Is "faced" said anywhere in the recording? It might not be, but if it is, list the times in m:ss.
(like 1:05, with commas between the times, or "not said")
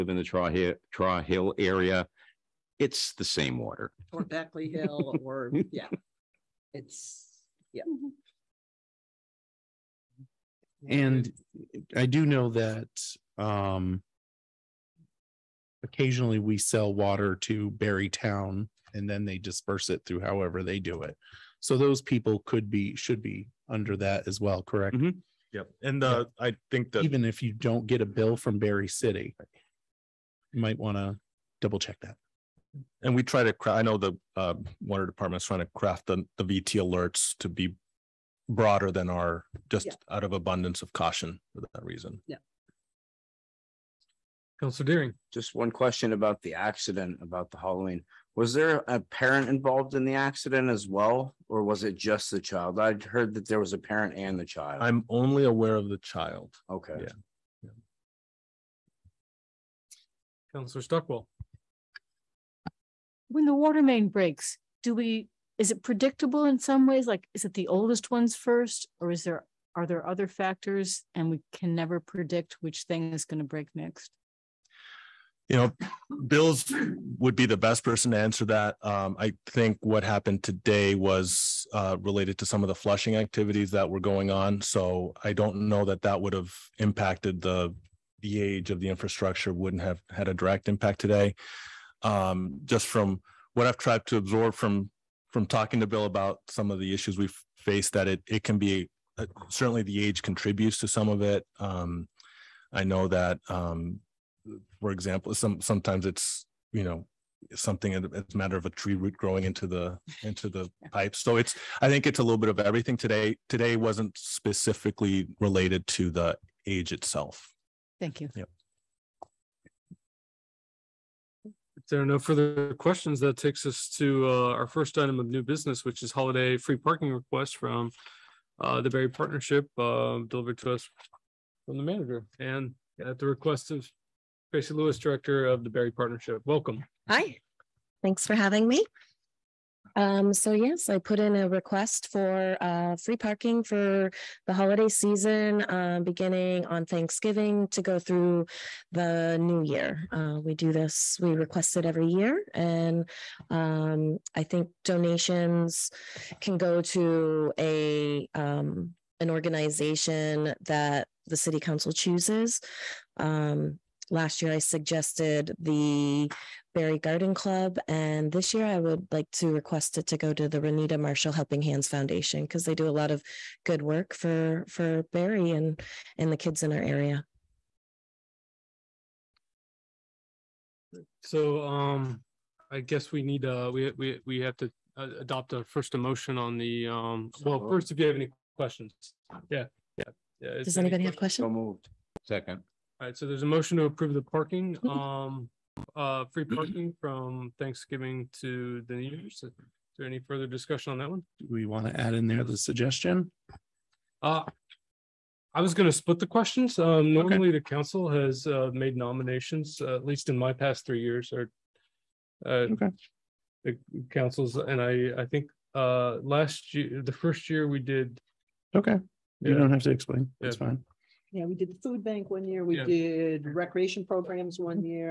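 1:37.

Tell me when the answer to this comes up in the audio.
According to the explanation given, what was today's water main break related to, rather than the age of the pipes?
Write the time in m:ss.
1:22.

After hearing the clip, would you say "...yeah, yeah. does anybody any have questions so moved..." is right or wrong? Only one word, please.
right.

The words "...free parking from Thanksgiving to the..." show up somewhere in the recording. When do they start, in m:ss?
3:16.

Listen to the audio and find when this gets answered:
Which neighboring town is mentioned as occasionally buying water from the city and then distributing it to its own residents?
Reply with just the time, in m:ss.
0:17.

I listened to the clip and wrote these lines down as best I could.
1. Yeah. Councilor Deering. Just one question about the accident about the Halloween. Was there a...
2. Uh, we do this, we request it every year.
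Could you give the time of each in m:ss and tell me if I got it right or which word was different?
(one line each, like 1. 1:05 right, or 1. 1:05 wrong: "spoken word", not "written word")
1. 0:42 right
2. 2:30 right.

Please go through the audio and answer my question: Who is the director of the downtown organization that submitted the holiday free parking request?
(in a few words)
Tracy Lewis.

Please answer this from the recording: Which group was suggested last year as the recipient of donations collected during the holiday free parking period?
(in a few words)
Barre Garden Club.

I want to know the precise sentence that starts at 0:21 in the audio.
So those people could be should be under that as well, correct?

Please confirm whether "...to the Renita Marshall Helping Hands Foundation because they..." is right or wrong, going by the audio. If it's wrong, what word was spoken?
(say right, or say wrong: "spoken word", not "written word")
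right.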